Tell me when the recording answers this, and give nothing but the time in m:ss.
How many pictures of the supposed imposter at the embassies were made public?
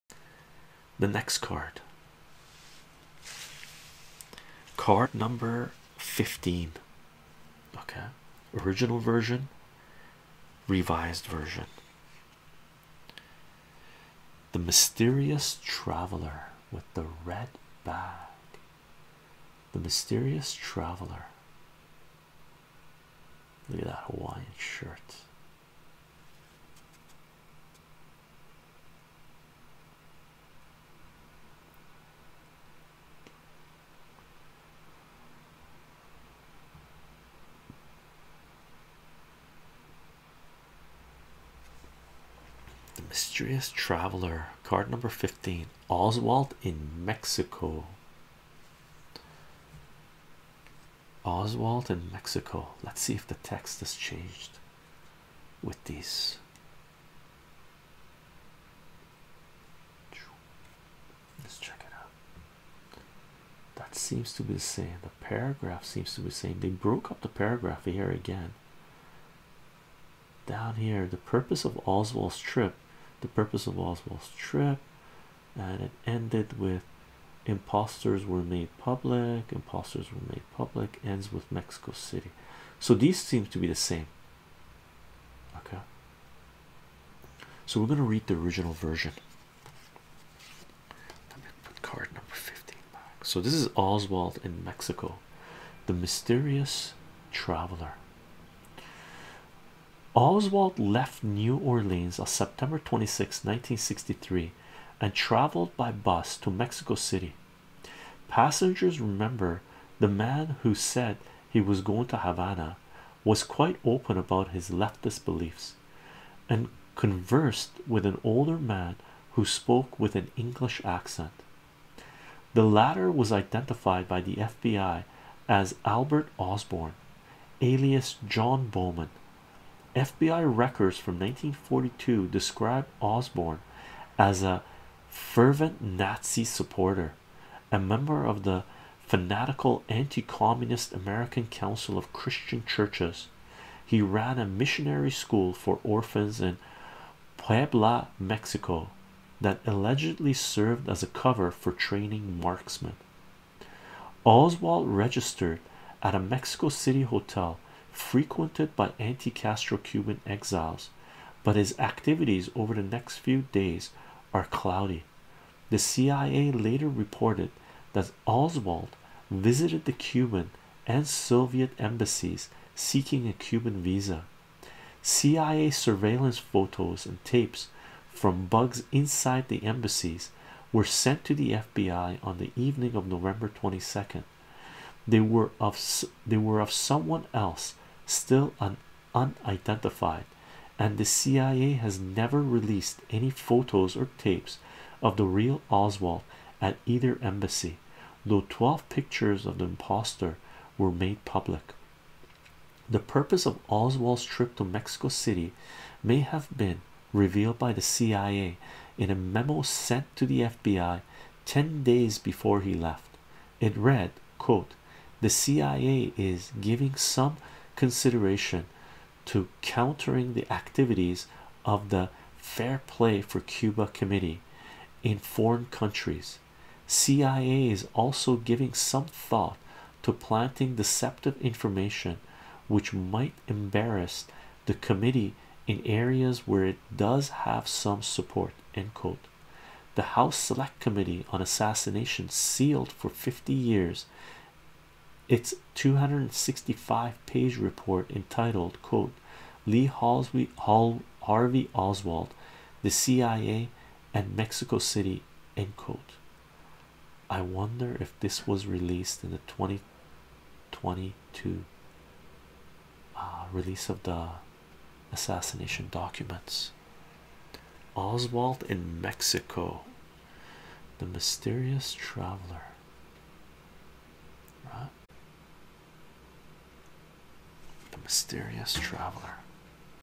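3:18.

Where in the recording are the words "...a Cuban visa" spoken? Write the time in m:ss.
2:53.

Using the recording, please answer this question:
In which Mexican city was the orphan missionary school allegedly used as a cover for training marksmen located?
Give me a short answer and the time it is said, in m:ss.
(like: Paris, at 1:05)
Puebla, at 2:27.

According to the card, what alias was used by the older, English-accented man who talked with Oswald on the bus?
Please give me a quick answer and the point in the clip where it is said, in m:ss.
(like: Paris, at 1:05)
John Bowman, at 2:08.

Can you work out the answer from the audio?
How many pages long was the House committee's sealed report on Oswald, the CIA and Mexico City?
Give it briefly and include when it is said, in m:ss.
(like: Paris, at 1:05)
265, at 4:05.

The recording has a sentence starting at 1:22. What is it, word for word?
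So these seem to be the same.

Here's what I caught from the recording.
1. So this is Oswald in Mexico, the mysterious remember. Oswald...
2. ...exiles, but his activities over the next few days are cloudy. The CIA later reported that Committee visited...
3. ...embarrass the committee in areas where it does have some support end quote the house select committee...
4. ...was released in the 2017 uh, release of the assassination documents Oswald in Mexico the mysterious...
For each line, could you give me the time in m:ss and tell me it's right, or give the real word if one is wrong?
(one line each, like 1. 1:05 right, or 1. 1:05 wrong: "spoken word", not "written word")
1. 1:33 wrong: "traveler", not "remember"
2. 2:40 wrong: "Oswald", not "Committee"
3. 3:53 right
4. 4:18 wrong: "2022", not "2017".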